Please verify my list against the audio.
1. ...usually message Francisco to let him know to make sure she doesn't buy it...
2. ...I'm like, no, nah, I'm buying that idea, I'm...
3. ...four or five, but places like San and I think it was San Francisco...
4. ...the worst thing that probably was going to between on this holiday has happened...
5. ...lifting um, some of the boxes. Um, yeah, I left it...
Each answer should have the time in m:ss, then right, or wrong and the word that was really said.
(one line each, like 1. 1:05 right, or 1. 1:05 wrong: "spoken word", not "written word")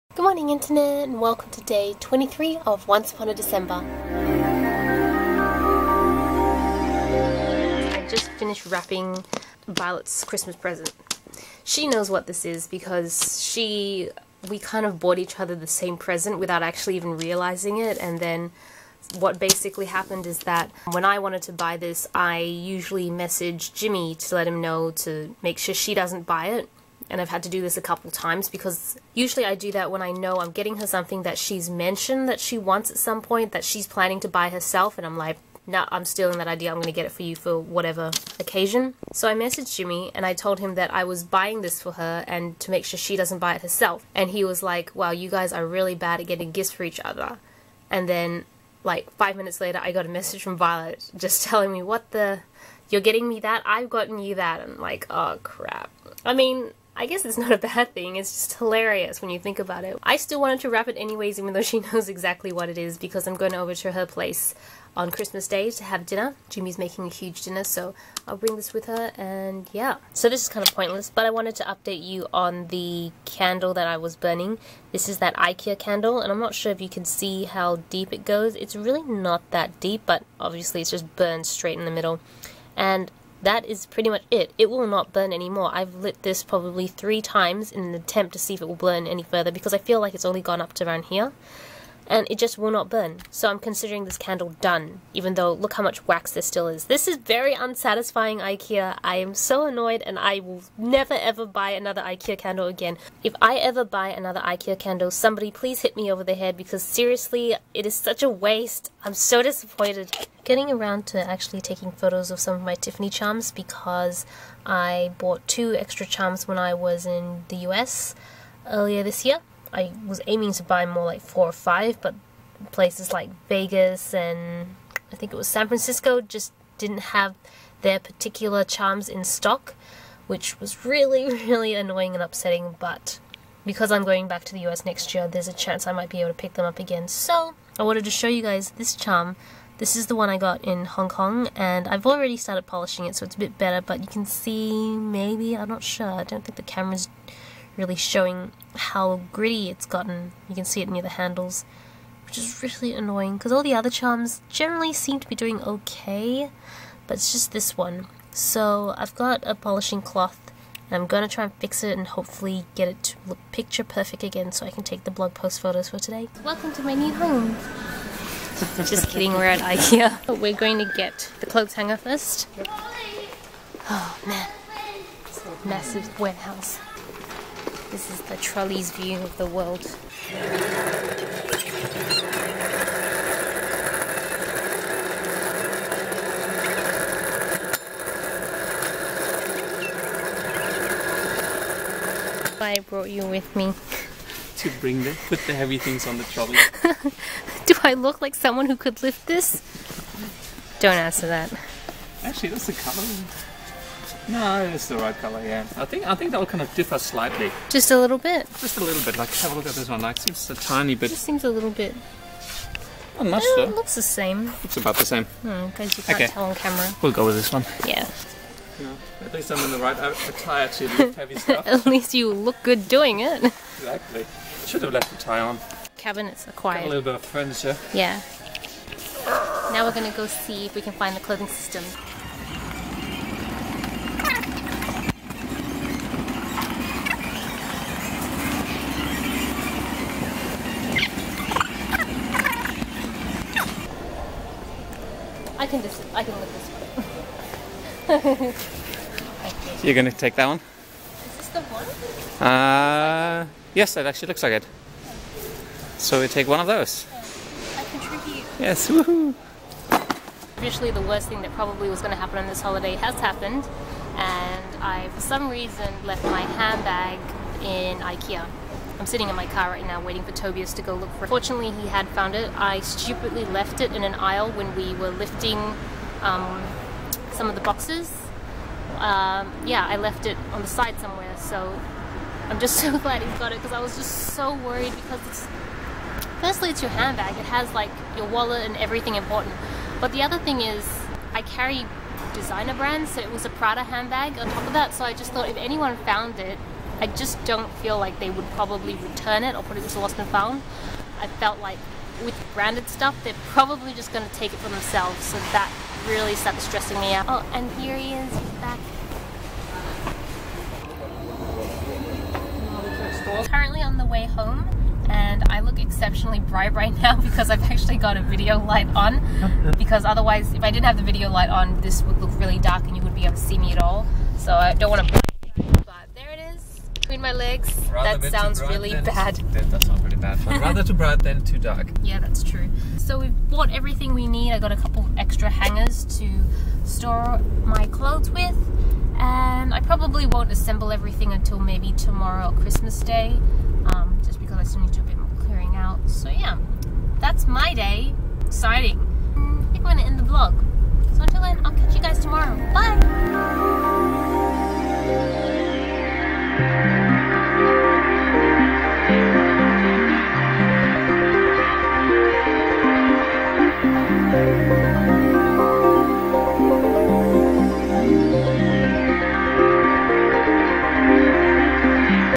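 1. 0:22 wrong: "Jimmy", not "Francisco"
2. 0:35 wrong: "stealing", not "buying"
3. 2:01 wrong: "Vegas", not "San"
4. 4:20 wrong: "happen", not "between"
5. 4:35 right.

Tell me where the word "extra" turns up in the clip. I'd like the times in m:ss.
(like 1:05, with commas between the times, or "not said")
1:55, 5:35.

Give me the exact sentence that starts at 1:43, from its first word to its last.
If I ever buy another IKEA candle, somebody please hit me over the head because seriously, it is such a waste.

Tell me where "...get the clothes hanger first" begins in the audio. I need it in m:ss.
2:50.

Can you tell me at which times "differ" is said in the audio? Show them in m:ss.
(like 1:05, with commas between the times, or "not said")
3:26.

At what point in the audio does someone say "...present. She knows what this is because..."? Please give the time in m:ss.
0:10.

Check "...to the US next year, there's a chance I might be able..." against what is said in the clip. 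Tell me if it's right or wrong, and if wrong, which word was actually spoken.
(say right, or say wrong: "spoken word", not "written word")
right.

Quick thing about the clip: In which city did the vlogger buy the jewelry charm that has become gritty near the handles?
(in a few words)
Hong Kong.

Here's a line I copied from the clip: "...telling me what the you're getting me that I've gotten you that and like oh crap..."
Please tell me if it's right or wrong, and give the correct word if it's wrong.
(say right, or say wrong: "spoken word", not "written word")
right.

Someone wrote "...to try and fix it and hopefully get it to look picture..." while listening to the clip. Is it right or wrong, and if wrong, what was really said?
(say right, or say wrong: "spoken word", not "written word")
right.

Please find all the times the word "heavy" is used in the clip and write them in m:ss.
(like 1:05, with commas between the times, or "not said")
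3:15, 3:41.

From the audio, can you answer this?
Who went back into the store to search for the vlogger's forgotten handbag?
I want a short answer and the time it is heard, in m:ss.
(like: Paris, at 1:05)
Tobias, at 4:30.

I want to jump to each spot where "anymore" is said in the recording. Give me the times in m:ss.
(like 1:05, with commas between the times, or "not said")
1:25.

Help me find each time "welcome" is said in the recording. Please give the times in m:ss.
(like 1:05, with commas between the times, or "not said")
0:01, 2:46.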